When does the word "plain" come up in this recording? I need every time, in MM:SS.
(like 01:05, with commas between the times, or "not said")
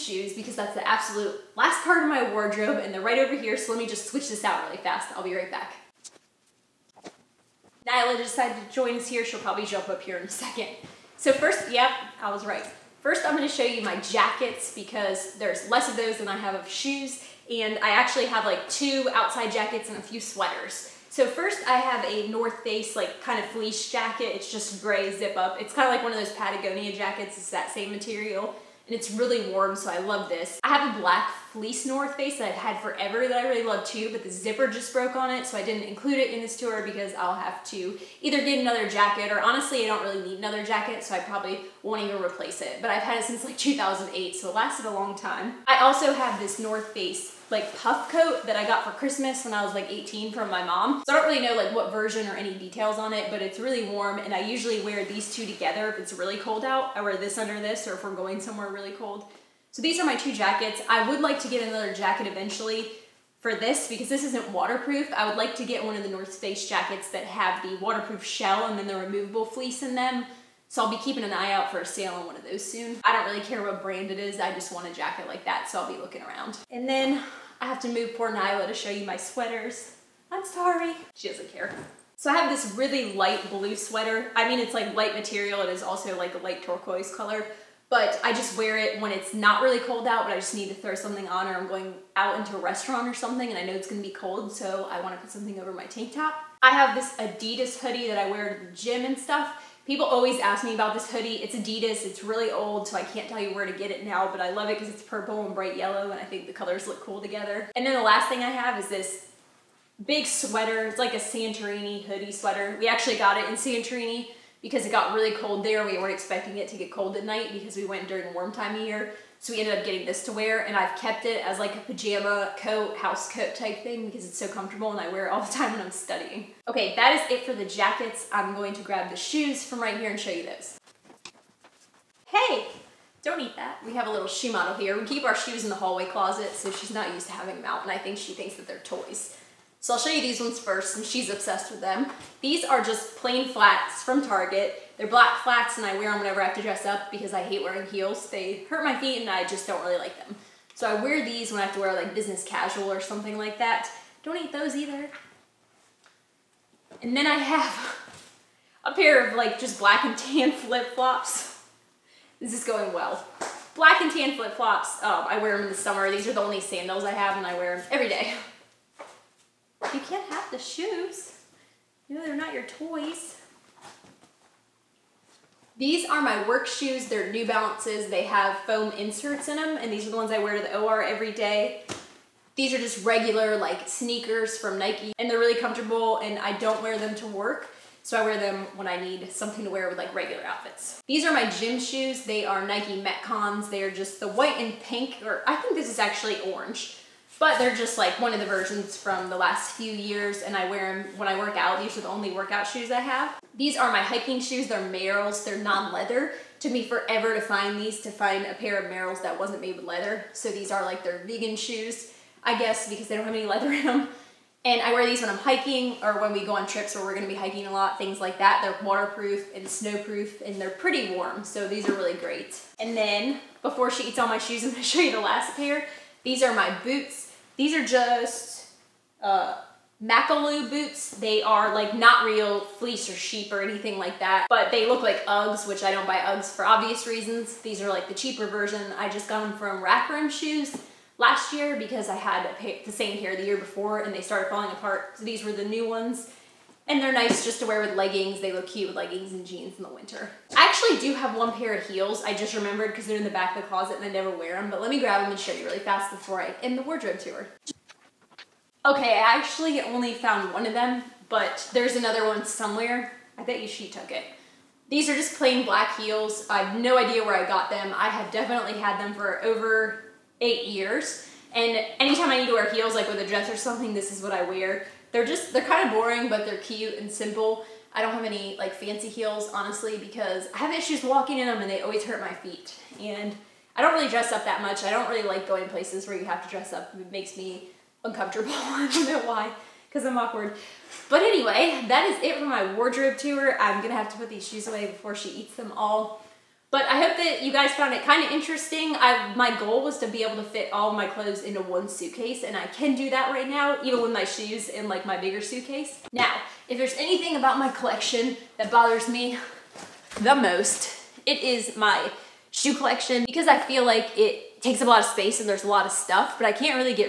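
02:23, 04:25.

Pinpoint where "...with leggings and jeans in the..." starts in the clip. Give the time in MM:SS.
04:08.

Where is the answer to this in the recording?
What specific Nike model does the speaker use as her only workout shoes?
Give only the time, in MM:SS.
03:13.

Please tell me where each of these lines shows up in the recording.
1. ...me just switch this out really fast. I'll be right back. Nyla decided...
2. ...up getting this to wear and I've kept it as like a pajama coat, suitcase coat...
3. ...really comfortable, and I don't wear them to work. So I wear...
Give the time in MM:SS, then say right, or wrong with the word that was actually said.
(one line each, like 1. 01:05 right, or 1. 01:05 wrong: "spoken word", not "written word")
1. 00:03 right
2. 01:59 wrong: "house", not "suitcase"
3. 03:05 right.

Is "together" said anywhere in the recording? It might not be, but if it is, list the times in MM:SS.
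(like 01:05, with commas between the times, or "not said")
00:55, 01:47.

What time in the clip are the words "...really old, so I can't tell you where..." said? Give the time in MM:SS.
01:42.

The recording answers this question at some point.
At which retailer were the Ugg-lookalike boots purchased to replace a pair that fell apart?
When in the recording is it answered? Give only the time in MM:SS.
03:59.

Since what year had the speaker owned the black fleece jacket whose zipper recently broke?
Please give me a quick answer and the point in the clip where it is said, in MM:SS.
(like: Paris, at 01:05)
2008, at 00:43.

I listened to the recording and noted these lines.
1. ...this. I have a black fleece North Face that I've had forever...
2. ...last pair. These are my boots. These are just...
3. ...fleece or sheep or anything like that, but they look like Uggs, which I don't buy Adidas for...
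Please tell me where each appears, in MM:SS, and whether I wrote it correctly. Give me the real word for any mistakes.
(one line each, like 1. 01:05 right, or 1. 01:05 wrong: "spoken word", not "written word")
1. 00:30 right
2. 03:45 right
3. 03:52 wrong: "Uggs", not "Adidas".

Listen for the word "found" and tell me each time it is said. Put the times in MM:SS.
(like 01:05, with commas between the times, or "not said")
04:20, 04:57.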